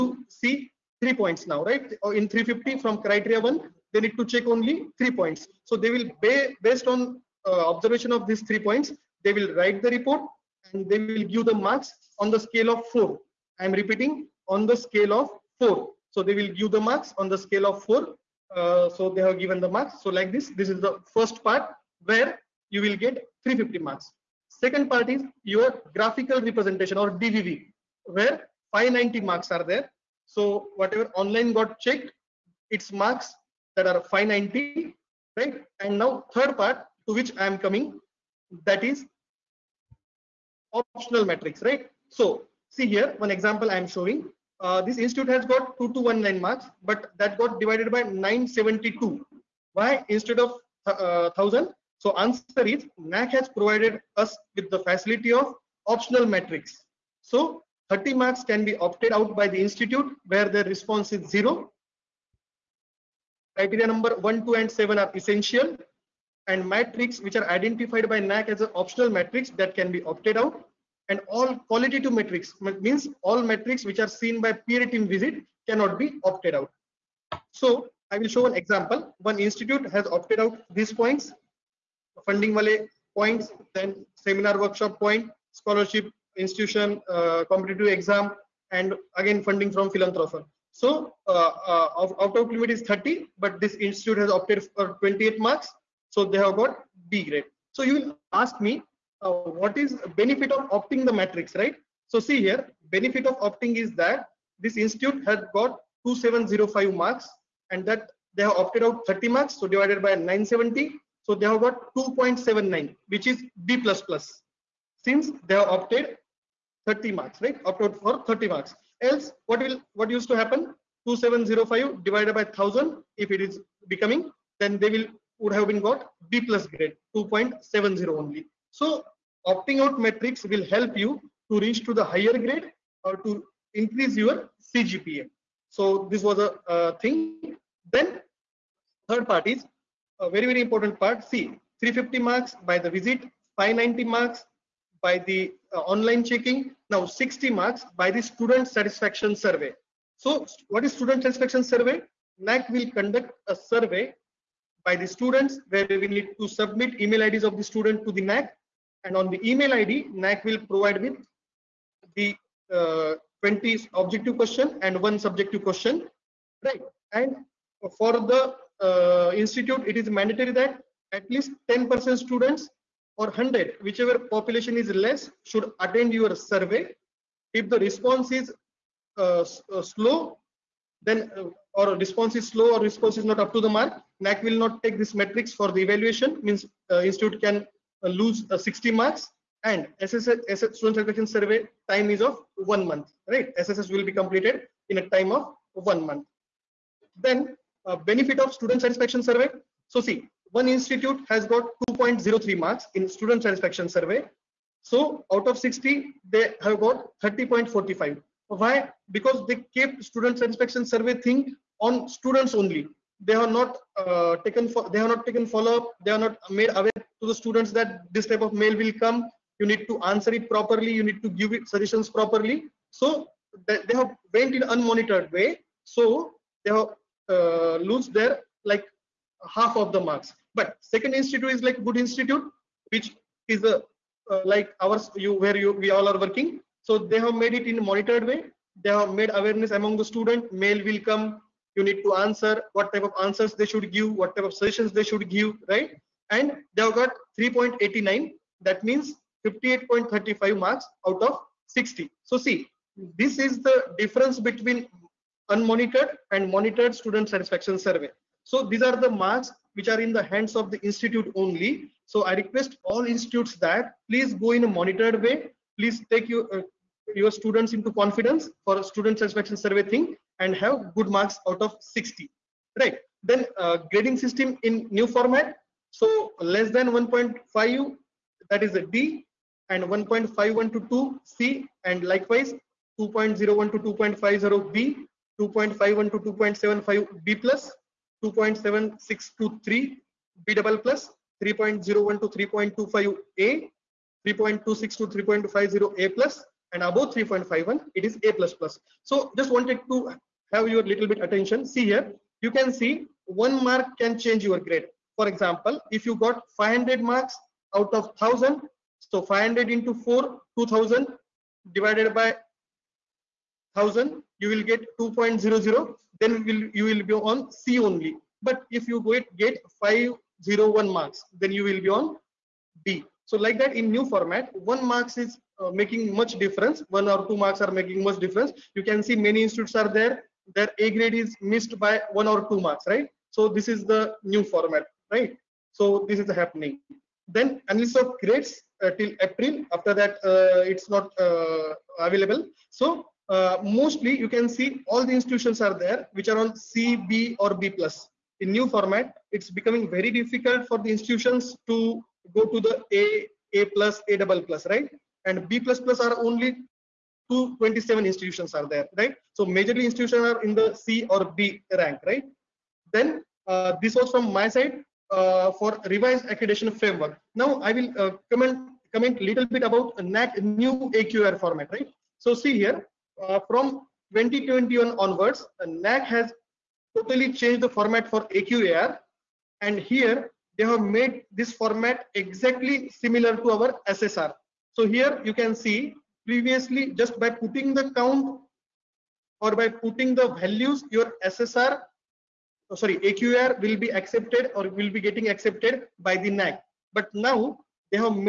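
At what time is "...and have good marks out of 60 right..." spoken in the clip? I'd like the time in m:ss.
4:30.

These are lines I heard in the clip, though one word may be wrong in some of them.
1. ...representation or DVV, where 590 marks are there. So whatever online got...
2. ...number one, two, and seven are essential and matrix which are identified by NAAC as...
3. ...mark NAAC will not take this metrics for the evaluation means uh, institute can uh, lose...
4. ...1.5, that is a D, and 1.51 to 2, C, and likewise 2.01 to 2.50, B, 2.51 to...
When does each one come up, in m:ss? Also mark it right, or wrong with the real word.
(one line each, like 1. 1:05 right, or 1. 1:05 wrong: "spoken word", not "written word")
1. 0:26 right
2. 1:03 right
3. 3:03 right
4. 4:36 right.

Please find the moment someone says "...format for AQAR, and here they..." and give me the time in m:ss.
6:17.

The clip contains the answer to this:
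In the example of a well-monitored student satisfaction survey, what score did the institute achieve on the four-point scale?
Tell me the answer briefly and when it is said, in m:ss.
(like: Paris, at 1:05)
3.89, at 4:07.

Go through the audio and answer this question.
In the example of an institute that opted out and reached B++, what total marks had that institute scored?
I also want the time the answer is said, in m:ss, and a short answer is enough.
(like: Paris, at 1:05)
2705, at 1:46.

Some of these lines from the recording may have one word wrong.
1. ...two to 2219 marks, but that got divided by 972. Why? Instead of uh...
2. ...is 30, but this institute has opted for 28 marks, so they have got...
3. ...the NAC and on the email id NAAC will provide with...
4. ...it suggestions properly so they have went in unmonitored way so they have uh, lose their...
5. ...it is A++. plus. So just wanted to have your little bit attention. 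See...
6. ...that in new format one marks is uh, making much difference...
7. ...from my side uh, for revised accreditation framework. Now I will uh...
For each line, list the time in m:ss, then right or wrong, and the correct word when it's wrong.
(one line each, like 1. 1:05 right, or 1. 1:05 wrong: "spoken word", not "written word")
1. 0:45 right
2. 1:32 right
3. 2:38 right
4. 3:41 right
5. 4:57 right
6. 5:23 right
7. 6:04 right.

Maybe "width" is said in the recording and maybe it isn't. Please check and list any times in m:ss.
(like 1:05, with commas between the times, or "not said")
not said.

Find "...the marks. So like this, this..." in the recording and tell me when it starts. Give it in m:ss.
0:19.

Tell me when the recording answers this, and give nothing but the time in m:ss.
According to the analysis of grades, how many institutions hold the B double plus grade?
5:57.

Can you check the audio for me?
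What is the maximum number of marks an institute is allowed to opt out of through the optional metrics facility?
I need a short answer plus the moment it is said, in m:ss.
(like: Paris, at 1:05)
30, at 0:57.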